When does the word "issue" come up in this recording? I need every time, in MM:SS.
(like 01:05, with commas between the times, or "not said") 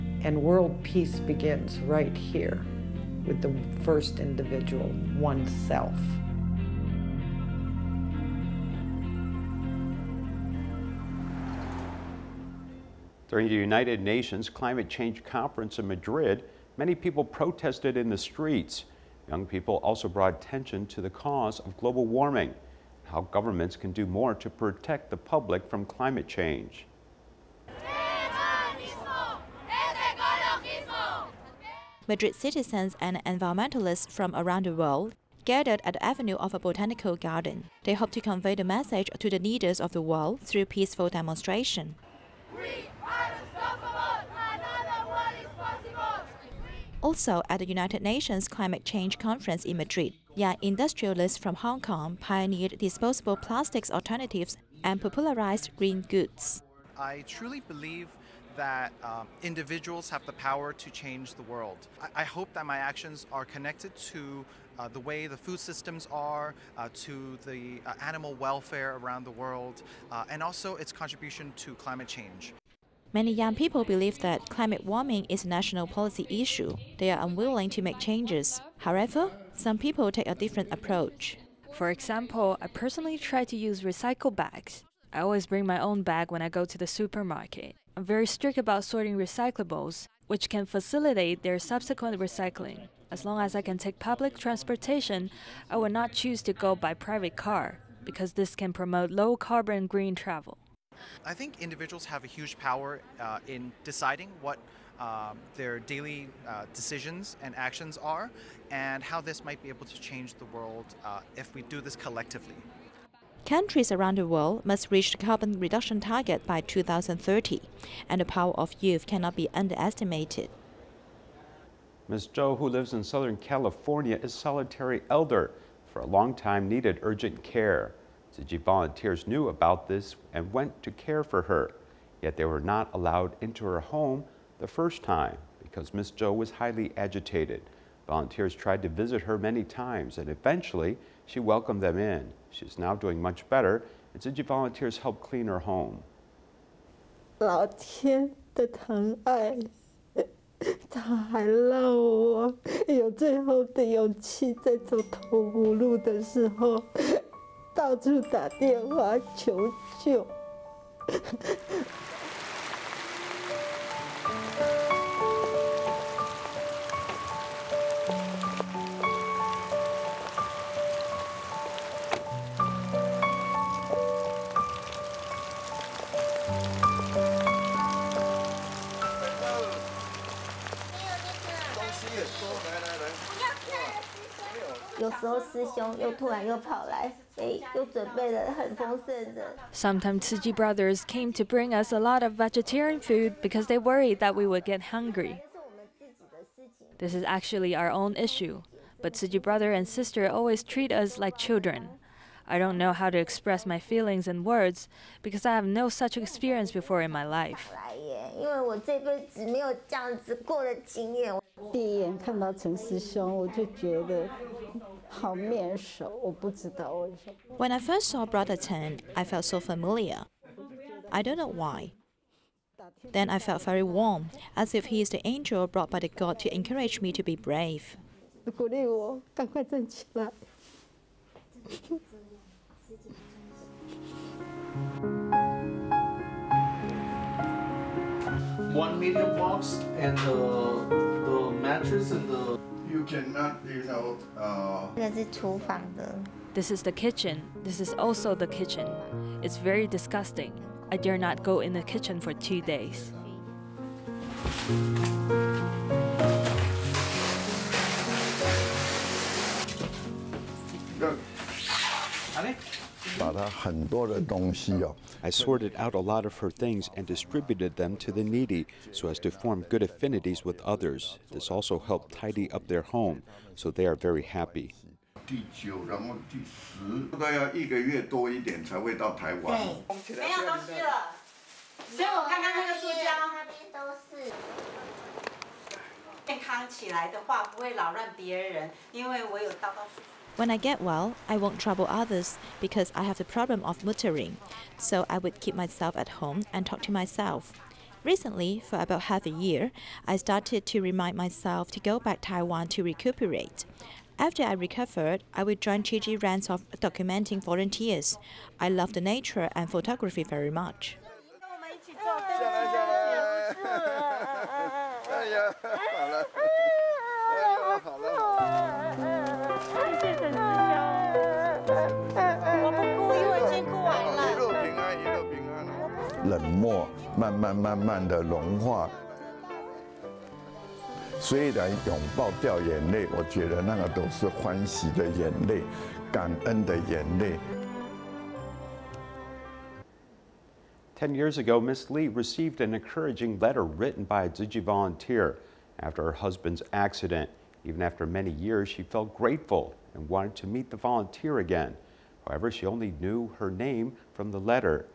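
01:16, 03:18.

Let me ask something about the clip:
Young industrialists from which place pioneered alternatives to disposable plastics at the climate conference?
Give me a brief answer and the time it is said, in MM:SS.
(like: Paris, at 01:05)
Hong Kong, at 00:51.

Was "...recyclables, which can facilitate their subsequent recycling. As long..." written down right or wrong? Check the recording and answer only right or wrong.
right.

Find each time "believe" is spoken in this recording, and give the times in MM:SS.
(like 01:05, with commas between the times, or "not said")
00:57, 01:13.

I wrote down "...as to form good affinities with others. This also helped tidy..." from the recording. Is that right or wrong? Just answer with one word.
right.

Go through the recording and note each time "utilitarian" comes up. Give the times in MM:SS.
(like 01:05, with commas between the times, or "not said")
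not said.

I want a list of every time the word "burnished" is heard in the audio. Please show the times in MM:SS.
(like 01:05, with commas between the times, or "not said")
not said.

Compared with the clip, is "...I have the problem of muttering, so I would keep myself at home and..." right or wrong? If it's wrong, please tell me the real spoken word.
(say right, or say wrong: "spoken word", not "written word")
right.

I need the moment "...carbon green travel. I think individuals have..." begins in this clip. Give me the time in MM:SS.
01:39.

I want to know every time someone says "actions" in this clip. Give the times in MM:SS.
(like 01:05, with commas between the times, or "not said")
01:02, 01:47.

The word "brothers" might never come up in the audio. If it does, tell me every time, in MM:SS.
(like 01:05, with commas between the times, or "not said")
03:10, 03:19, 03:38.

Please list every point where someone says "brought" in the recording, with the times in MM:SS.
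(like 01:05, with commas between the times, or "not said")
00:20, 03:45.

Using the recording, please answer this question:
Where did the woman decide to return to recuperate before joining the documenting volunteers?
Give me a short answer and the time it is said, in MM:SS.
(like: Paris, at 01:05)
Taiwan, at 05:02.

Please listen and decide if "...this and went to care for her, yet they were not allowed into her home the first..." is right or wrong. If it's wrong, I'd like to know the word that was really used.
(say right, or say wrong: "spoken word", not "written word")
right.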